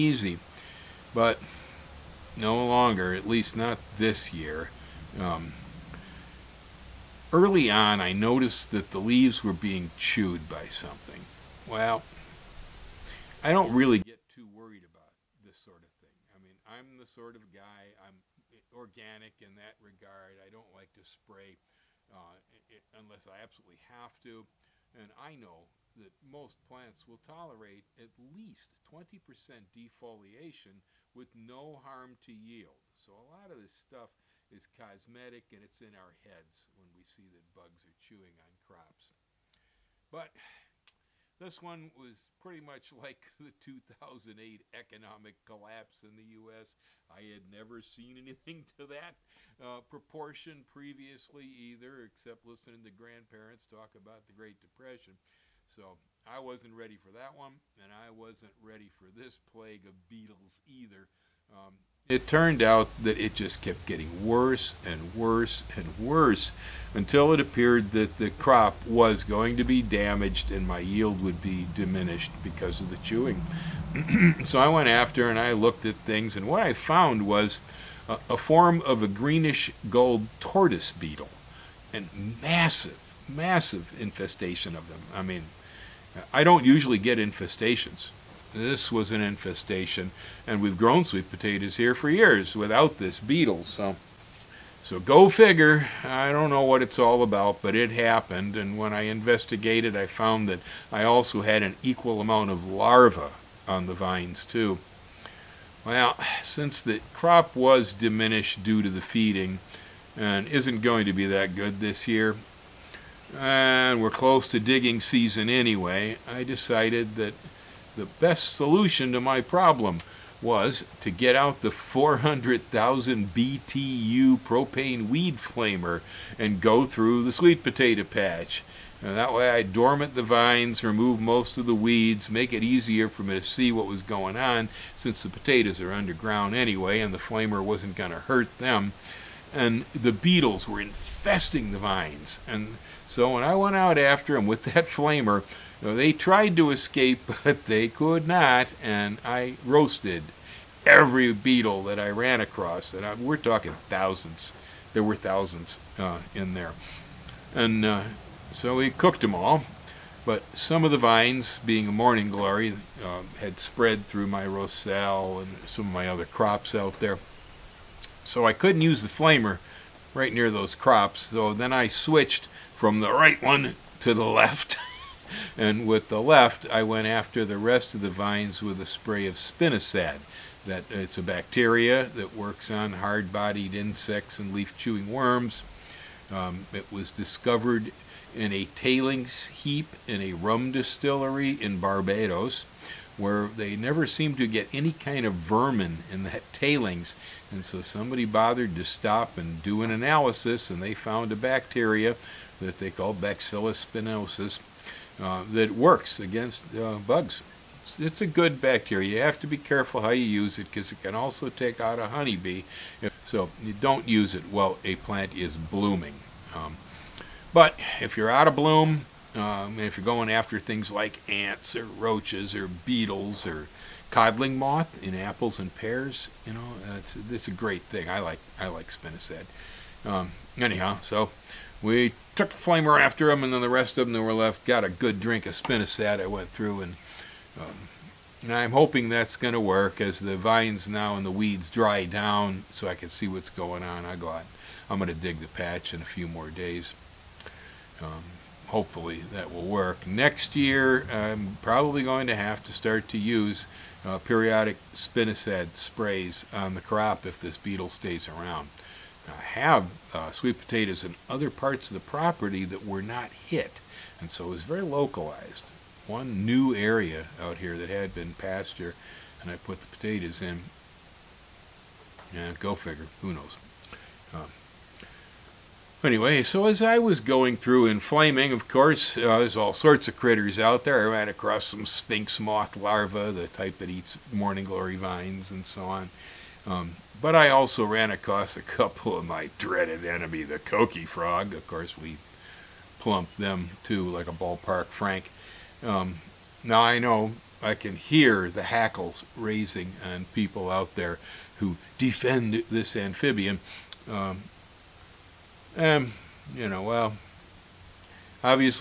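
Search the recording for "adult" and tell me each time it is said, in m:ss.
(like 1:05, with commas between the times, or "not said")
not said.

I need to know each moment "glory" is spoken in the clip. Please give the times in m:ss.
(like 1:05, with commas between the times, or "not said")
2:42, 4:44.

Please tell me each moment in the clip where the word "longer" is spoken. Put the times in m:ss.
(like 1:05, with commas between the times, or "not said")
0:02.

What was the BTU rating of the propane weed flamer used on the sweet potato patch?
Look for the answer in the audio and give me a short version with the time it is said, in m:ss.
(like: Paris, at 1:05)
400,000, at 2:01.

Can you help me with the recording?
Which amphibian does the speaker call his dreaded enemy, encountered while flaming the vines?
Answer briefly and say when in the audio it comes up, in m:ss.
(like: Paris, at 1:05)
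Coqui Frog, at 4:50.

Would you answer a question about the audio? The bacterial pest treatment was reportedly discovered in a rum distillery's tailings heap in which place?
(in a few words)
Barbados.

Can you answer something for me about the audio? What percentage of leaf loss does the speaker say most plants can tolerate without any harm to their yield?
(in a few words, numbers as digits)
20%.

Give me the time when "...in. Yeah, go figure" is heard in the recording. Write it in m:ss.
4:30.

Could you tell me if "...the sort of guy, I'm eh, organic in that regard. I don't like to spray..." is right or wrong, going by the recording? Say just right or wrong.
right.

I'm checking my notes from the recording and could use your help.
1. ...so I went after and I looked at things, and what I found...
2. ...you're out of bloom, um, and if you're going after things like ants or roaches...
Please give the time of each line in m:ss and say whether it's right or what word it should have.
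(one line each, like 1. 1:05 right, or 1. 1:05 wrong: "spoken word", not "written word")
1. 1:14 right
2. 3:38 right.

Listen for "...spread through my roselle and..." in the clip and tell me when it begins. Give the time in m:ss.
2:43.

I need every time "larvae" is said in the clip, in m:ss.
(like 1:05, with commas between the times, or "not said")
1:42, 4:42.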